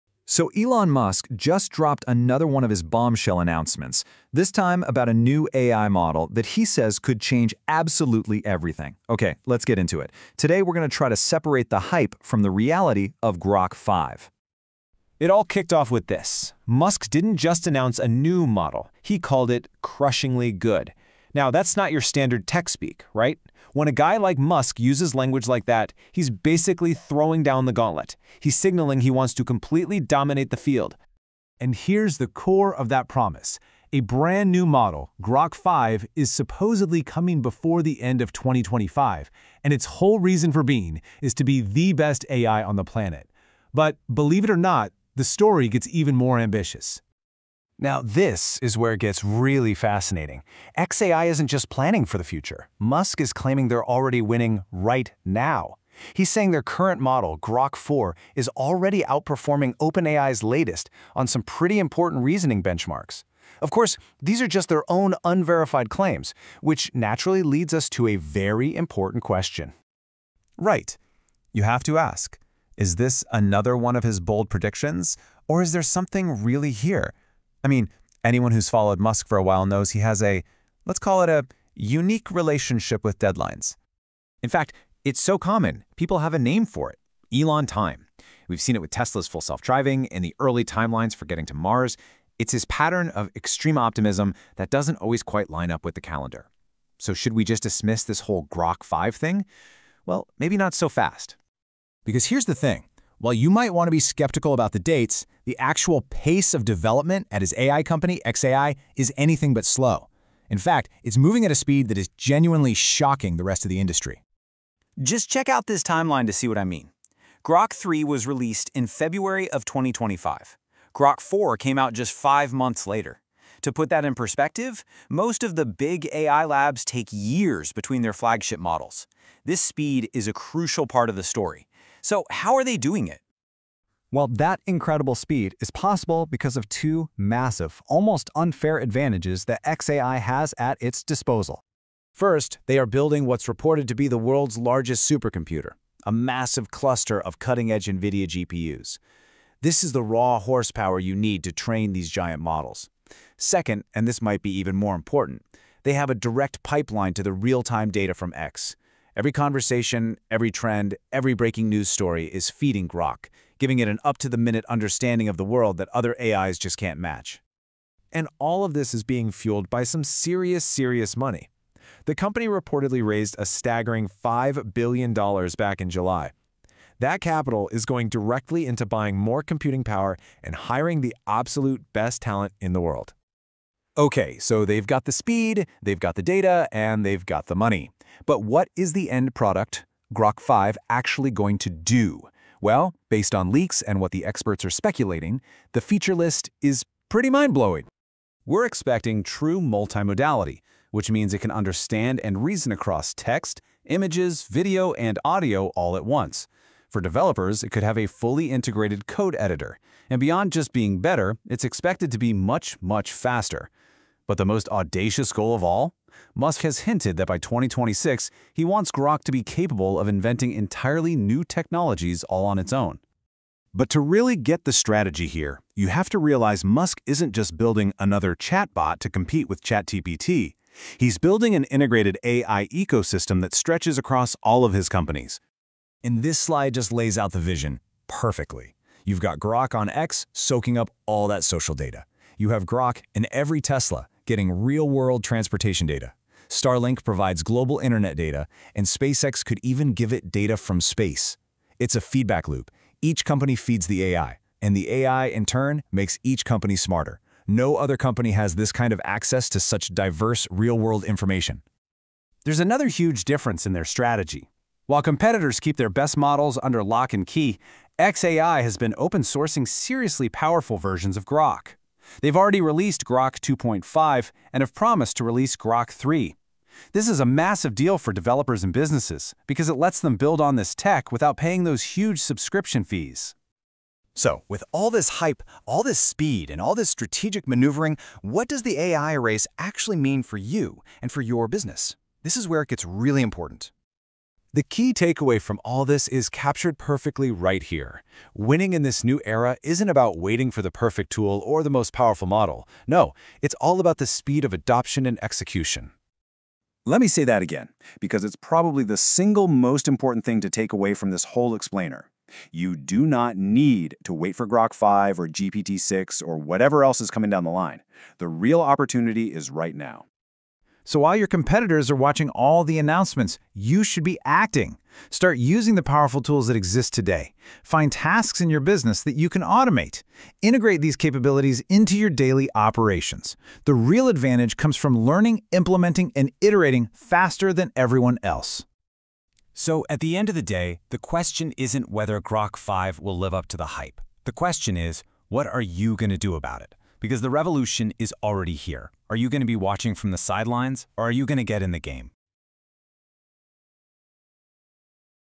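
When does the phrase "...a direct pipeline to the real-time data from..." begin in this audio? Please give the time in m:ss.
2:36.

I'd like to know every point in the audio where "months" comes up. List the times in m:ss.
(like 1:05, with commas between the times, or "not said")
2:02.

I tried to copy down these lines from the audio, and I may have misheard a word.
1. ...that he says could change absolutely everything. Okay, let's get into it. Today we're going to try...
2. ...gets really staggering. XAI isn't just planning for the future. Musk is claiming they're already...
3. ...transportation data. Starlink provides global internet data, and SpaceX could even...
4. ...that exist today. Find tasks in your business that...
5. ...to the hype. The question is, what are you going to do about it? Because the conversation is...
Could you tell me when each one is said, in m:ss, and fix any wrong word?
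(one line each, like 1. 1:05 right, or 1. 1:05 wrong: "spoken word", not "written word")
1. 0:06 right
2. 0:48 wrong: "fascinating", not "staggering"
3. 4:05 right
4. 5:26 right
5. 5:43 wrong: "revolution", not "conversation".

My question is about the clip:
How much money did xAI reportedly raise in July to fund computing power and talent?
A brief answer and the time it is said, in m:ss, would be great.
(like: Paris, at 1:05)
$5 billion, at 2:54.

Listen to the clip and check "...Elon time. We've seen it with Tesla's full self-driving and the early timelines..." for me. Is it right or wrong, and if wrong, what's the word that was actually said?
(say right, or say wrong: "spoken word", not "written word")
right.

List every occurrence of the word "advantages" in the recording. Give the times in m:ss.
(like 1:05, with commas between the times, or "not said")
2:18, 5:34.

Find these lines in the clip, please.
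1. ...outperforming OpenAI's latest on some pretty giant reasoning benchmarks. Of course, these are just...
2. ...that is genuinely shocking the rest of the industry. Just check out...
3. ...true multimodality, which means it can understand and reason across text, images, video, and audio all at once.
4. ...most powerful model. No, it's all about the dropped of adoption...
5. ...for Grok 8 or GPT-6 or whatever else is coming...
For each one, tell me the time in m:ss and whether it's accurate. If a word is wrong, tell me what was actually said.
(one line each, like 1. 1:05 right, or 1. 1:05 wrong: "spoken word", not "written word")
1. 0:59 wrong: "important", not "giant"
2. 1:51 right
3. 3:19 right
4. 5:01 wrong: "speed", not "dropped"
5. 5:14 wrong: "5", not "8".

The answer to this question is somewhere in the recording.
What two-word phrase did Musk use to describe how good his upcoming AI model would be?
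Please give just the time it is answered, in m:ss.
0:19.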